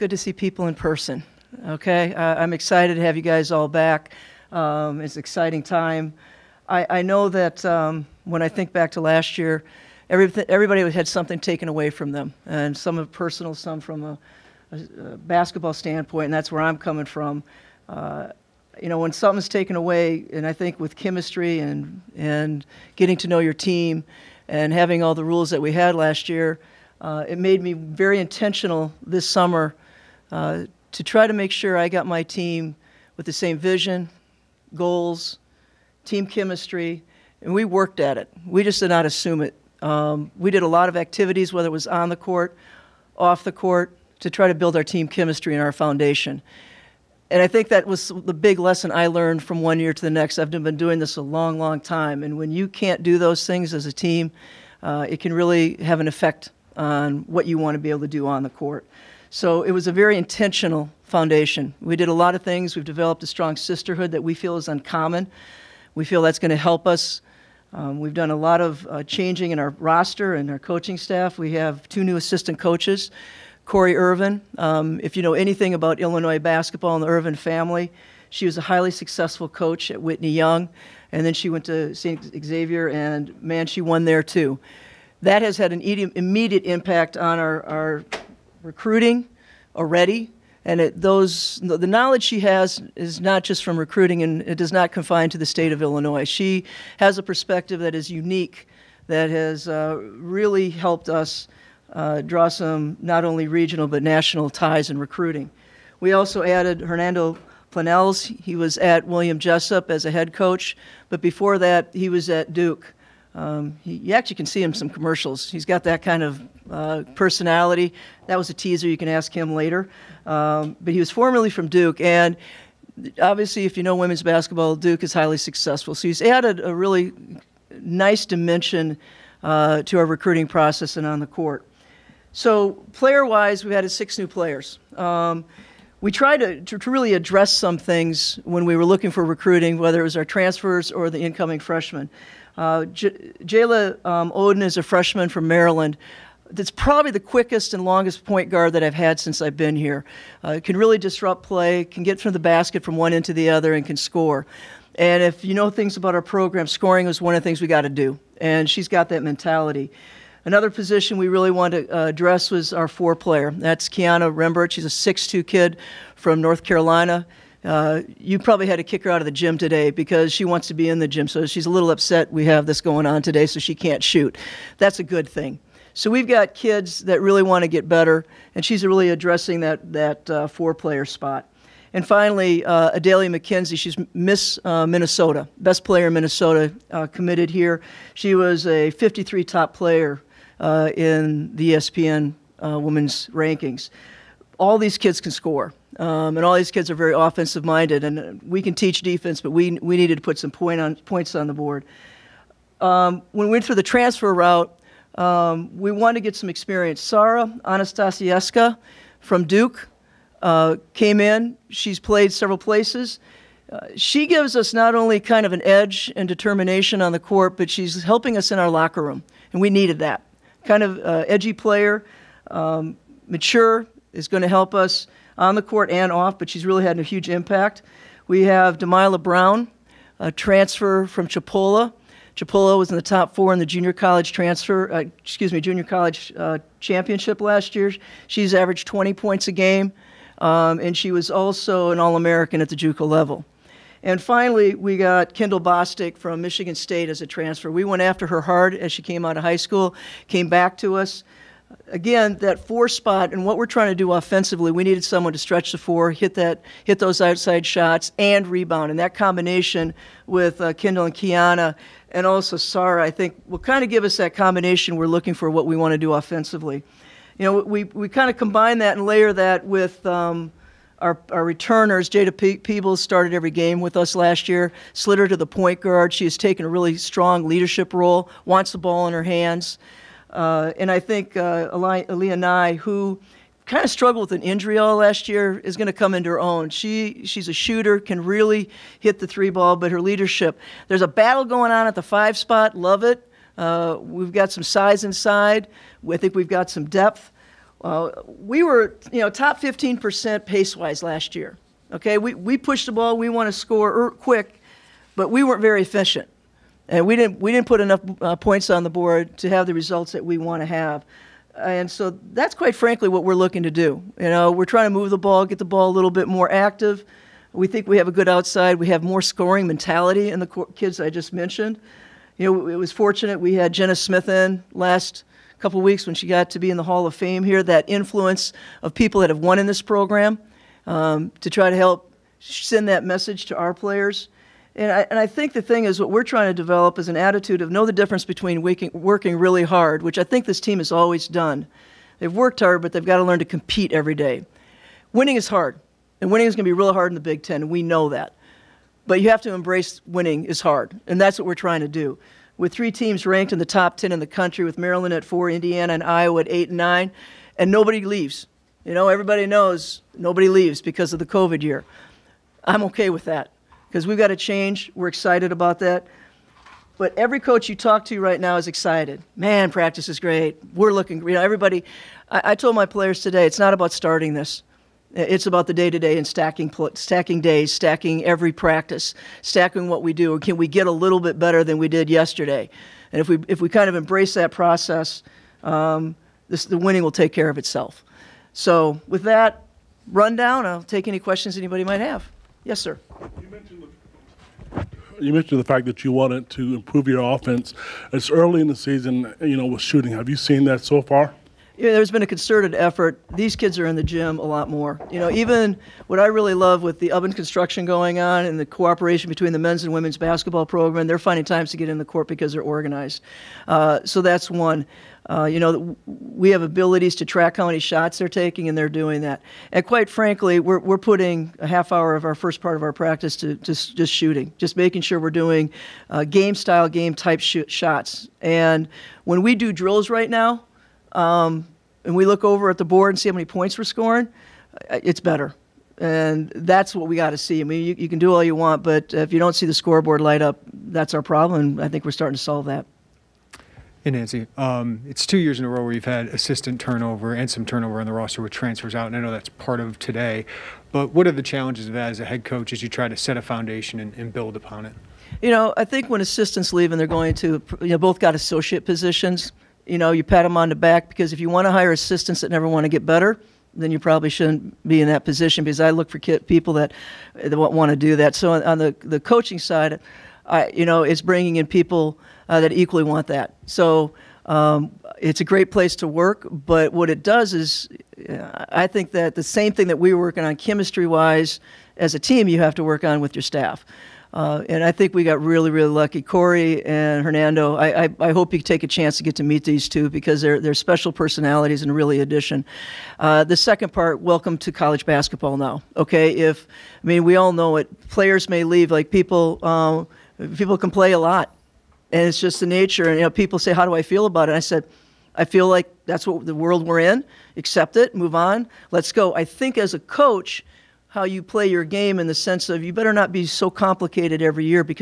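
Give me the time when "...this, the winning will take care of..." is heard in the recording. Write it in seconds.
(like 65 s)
386 s.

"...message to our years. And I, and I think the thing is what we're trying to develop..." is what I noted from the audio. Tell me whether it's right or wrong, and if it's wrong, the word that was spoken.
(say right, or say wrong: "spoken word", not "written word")
wrong: "players", not "years".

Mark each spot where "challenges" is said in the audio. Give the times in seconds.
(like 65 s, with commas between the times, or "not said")
451 s.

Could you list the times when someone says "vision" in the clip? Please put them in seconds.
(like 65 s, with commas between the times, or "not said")
33 s.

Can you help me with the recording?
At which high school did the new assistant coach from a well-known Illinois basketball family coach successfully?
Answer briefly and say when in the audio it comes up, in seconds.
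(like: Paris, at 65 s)
Whitney Young, at 80 s.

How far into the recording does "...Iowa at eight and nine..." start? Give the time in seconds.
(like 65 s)
356 s.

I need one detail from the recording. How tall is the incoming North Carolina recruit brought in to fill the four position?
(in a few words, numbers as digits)
6'2.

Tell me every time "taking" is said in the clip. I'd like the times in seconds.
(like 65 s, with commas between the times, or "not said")
418 s.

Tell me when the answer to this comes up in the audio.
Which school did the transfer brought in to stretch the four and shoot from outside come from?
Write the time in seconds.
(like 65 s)
246 s.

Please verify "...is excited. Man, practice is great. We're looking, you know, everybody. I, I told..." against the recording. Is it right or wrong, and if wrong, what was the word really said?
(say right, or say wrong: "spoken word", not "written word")
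right.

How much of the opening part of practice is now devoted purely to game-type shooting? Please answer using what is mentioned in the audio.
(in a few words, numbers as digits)
half hour.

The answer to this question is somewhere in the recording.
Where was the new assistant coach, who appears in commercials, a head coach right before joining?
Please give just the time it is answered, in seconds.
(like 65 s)
109 s.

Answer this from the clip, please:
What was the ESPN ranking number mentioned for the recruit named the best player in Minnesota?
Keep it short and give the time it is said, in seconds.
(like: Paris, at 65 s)
53, at 188 s.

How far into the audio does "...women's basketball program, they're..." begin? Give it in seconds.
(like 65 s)
409 s.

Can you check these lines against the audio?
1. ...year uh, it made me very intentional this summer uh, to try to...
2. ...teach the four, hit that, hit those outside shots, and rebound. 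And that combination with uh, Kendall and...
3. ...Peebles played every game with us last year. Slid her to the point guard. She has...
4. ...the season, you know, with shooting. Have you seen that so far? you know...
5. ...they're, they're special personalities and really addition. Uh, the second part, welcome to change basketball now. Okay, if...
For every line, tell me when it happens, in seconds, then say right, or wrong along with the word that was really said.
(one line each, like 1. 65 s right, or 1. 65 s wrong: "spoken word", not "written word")
1. 26 s right
2. 255 s wrong: "stretch", not "teach"
3. 272 s wrong: "started", not "played"
4. 398 s right
5. 490 s wrong: "college", not "change".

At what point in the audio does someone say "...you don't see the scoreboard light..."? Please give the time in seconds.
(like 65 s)
439 s.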